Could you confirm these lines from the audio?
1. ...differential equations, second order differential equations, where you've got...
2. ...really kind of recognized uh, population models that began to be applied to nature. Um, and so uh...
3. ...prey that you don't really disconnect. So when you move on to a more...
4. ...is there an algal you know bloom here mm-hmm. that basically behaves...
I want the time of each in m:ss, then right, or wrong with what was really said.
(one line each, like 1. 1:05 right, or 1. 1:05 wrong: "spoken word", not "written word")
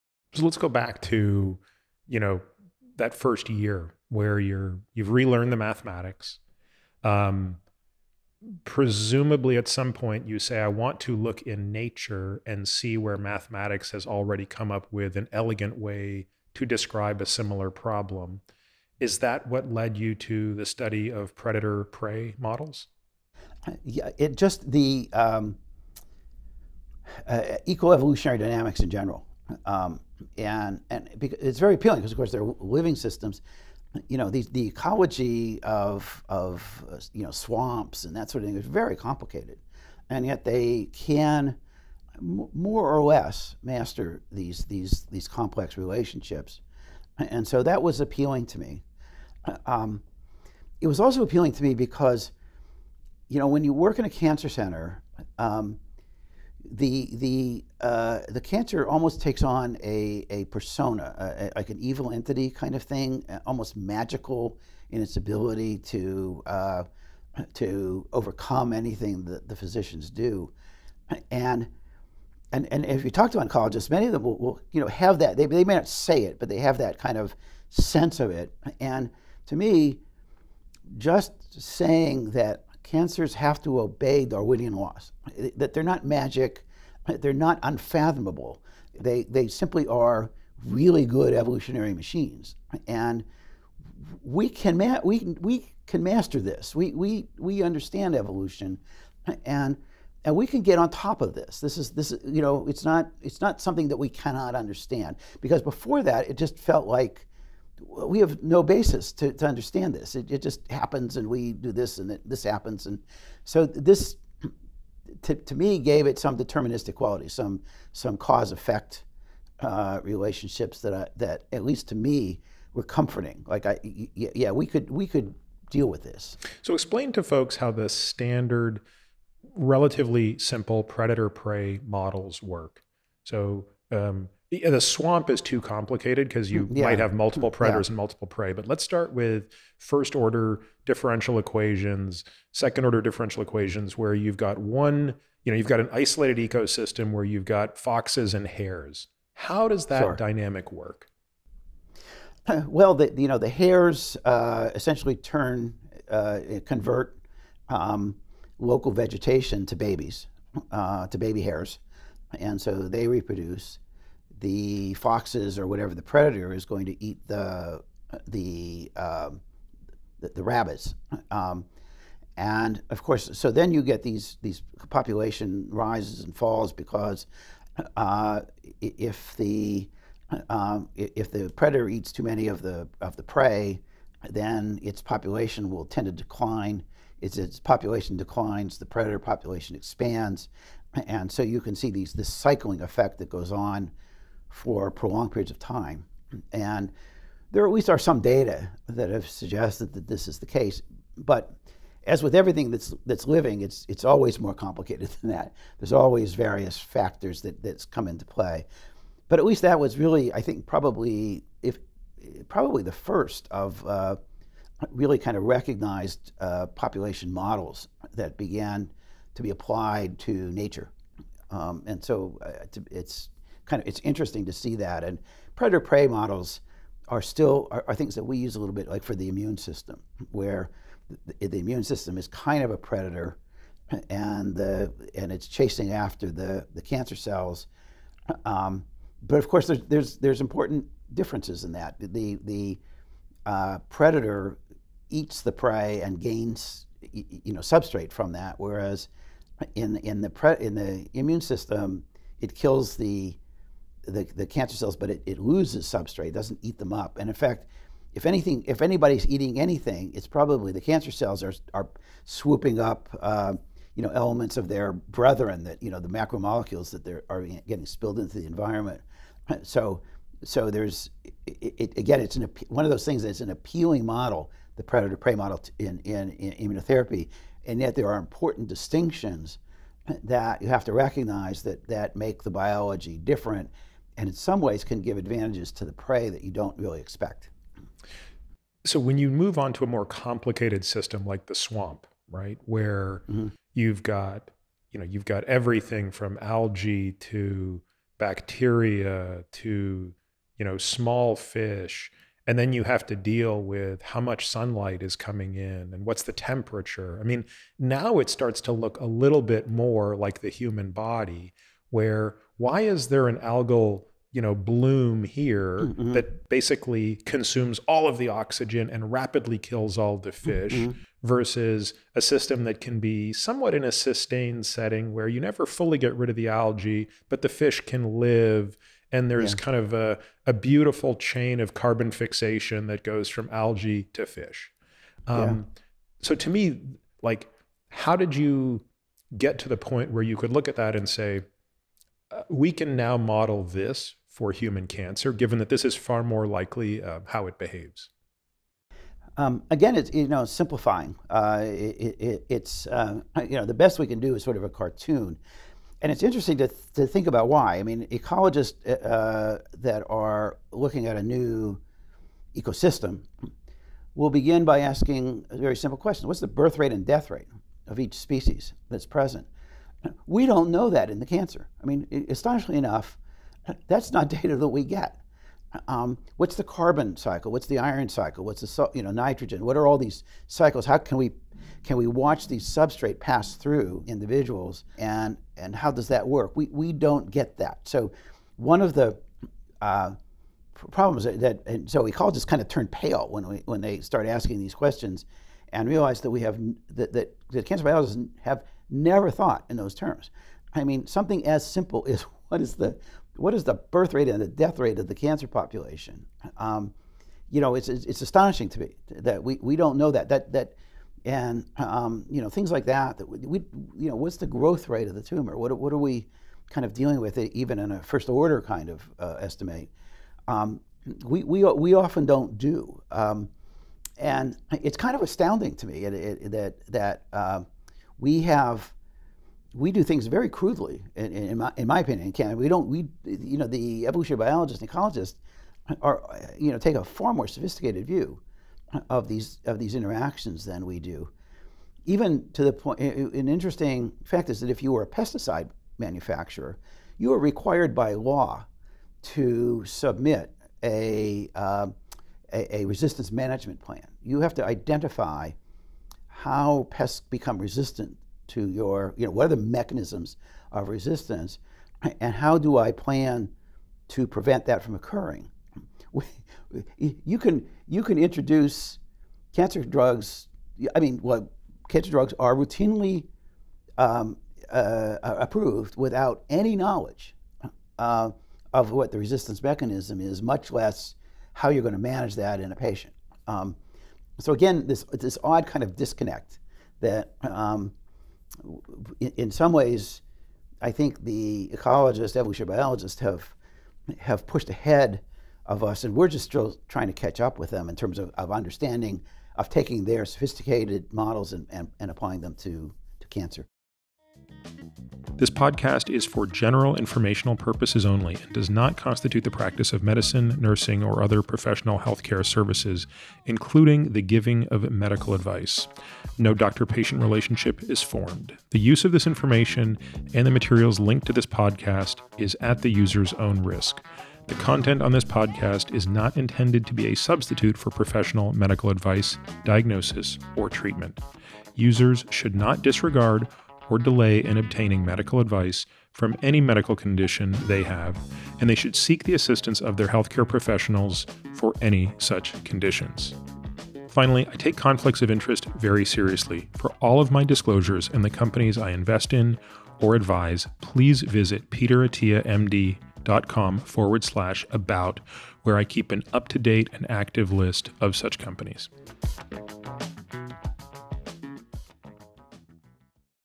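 1. 2:20 right
2. 3:34 right
3. 4:45 wrong: "expect", not "disconnect"
4. 5:12 wrong: "consumes", not "behaves".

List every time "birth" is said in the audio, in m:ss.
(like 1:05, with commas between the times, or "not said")
6:06, 6:43.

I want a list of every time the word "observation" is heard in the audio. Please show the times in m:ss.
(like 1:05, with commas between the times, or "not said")
not said.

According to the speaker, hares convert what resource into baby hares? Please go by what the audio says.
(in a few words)
Local vegetation.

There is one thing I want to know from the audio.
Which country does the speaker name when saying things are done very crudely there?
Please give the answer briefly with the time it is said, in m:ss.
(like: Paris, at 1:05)
Canada, at 7:12.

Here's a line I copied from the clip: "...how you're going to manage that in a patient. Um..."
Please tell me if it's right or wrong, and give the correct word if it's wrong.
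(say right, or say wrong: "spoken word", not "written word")
right.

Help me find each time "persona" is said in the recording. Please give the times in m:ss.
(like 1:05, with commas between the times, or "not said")
1:00.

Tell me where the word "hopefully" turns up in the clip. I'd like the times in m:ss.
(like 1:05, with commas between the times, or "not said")
not said.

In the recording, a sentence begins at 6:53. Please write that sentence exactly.
That we, you know what's the growth rate of the tumor?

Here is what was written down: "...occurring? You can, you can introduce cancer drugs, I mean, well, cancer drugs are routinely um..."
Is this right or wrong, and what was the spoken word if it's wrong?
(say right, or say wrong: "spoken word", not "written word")
right.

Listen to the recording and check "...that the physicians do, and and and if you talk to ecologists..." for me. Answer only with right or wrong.
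wrong.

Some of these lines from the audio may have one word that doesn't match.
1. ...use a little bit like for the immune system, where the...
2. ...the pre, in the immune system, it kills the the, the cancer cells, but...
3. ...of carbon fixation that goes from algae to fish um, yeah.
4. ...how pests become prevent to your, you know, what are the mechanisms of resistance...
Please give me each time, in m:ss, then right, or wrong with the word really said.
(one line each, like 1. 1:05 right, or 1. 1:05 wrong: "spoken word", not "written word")
1. 3:48 right
2. 4:10 right
3. 5:31 right
4. 7:36 wrong: "resistant", not "prevent".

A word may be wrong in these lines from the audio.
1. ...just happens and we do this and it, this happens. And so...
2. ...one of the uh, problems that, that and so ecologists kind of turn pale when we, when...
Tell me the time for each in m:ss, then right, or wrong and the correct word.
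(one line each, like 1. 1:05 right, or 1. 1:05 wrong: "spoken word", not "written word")
1. 1:50 right
2. 6:28 right.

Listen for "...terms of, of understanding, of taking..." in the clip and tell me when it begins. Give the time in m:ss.
8:17.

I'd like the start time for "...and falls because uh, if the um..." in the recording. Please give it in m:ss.
2:56.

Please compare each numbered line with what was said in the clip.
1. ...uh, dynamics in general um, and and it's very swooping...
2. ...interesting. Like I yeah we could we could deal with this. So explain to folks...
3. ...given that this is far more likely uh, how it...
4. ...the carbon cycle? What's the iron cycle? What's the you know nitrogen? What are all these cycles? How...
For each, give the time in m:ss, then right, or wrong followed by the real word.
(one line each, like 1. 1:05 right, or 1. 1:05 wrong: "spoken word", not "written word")
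1. 0:27 wrong: "appealing", not "swooping"
2. 2:02 wrong: "comforting", not "interesting"
3. 5:45 right
4. 6:16 right.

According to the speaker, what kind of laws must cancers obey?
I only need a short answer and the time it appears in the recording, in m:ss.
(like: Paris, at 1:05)
Darwinian laws, at 1:24.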